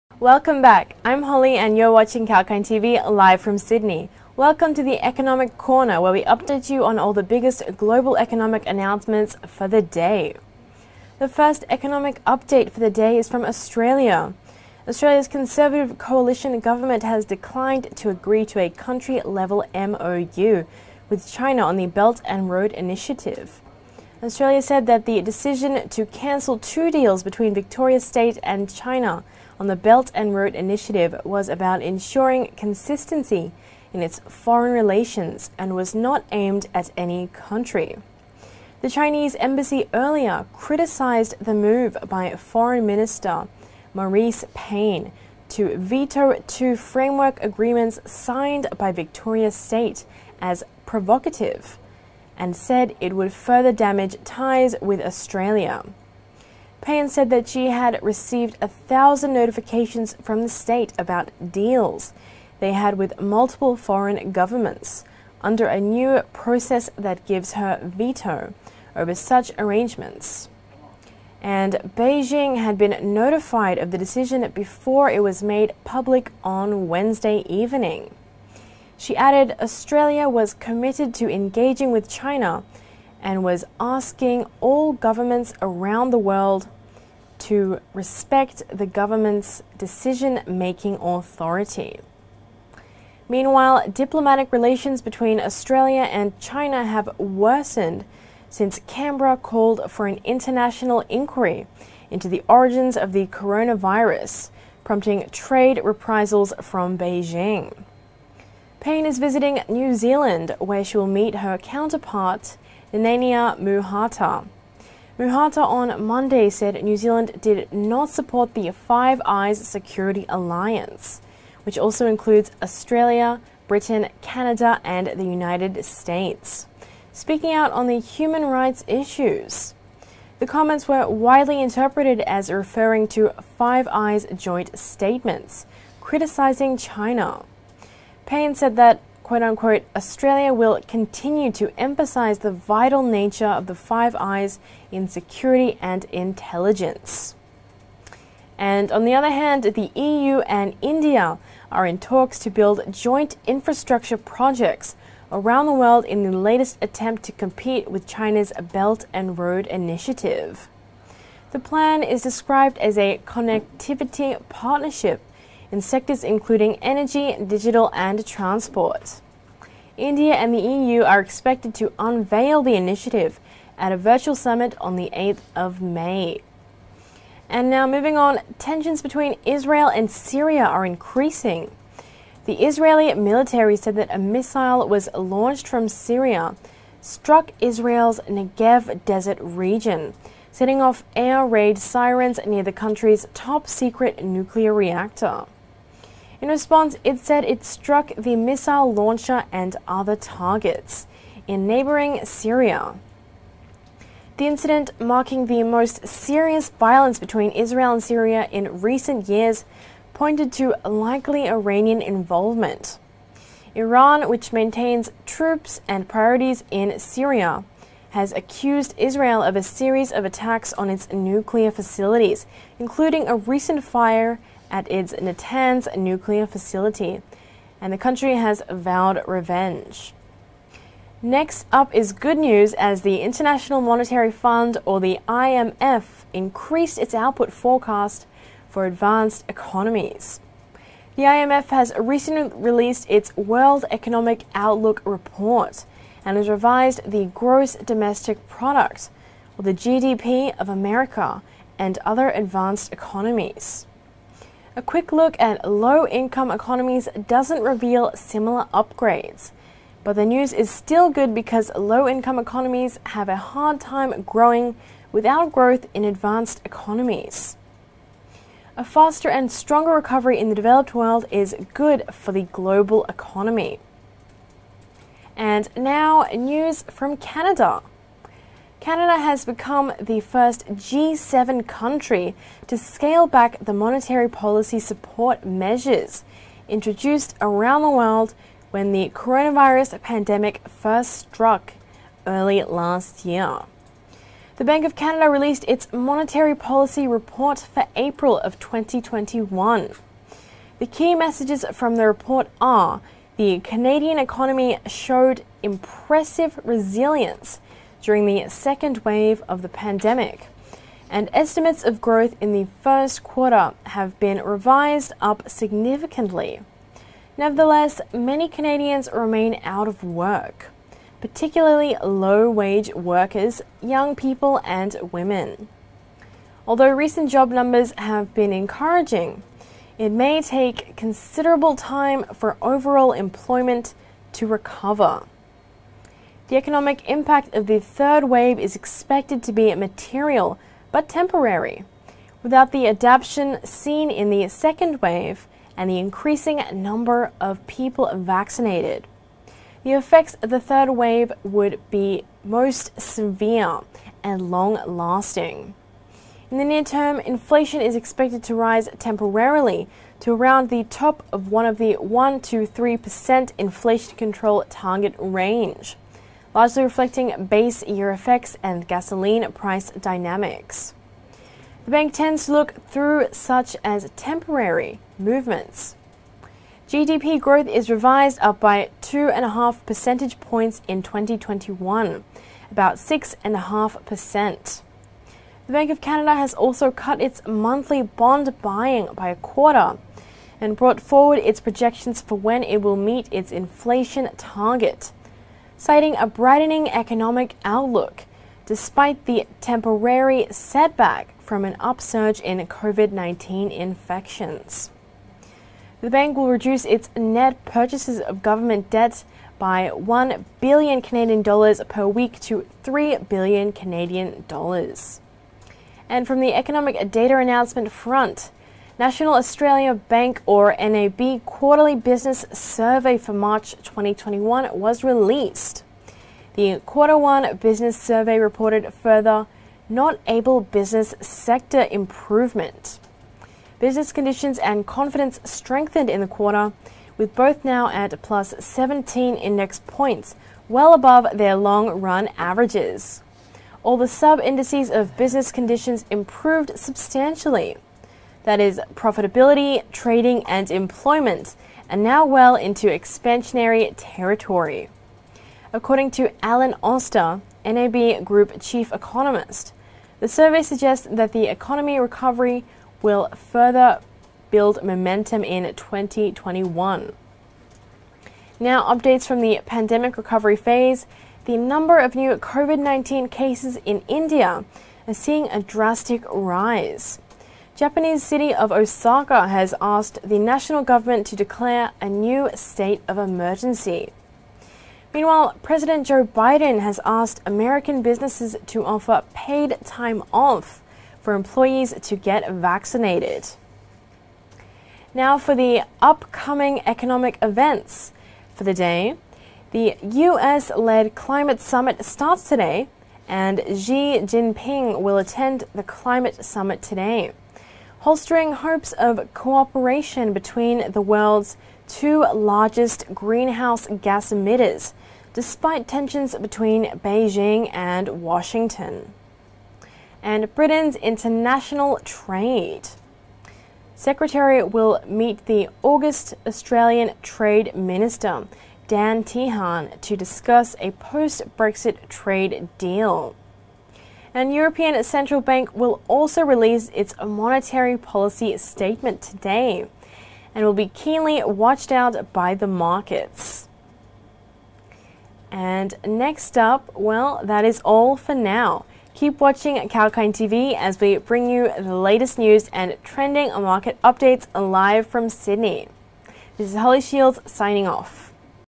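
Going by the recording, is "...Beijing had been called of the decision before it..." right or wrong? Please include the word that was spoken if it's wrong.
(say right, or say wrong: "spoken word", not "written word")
wrong: "notified", not "called".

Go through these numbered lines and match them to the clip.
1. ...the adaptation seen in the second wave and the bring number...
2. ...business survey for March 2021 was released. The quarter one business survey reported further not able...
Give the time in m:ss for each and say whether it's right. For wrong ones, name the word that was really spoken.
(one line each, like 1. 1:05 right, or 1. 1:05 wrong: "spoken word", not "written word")
1. 5:42 wrong: "increasing", not "bring"
2. 7:01 right.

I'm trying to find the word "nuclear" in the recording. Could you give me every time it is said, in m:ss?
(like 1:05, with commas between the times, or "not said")
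3:14, 3:41, 3:45.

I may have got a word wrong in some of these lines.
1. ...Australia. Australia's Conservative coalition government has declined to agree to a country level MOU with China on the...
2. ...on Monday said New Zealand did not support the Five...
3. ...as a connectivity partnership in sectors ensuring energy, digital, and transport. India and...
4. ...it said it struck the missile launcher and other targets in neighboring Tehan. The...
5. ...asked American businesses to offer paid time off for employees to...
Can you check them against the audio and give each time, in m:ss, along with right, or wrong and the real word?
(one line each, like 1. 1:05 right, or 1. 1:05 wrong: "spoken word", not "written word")
1. 0:13 right
2. 1:55 right
3. 2:42 wrong: "including", not "ensuring"
4. 3:17 wrong: "Syria", not "Tehan"
5. 8:07 right.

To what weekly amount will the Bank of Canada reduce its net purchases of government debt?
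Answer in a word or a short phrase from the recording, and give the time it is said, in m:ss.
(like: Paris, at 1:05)
3 billion Canadian dollars, at 6:52.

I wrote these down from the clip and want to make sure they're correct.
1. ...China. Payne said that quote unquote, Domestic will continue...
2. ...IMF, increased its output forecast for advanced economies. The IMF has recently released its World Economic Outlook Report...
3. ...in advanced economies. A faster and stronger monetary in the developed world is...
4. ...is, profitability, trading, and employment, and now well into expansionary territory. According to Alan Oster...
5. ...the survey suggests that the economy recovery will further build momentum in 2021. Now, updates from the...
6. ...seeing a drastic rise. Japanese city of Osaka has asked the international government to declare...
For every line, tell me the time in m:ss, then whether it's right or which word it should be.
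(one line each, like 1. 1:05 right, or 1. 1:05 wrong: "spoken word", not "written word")
1. 2:16 wrong: "Australia", not "Domestic"
2. 3:55 right
3. 4:25 wrong: "recovery", not "monetary"
4. 7:28 right
5. 7:40 right
6. 7:55 wrong: "national", not "international".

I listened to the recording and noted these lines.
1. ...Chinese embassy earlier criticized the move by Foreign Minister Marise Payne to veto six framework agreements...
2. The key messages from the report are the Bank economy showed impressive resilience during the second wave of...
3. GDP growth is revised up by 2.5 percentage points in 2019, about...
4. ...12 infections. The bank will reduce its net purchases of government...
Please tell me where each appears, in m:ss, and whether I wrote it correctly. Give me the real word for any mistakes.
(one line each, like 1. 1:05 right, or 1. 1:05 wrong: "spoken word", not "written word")
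1. 0:38 wrong: "two", not "six"
2. 5:00 wrong: "Canadian", not "Bank"
3. 6:16 wrong: "2021", not "2019"
4. 6:43 wrong: "19", not "12".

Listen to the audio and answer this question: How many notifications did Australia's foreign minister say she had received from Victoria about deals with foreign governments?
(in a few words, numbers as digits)
1000.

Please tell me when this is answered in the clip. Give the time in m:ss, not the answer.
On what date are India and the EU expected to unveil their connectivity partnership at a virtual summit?
2:55.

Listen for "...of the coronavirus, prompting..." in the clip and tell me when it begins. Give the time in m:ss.
1:42.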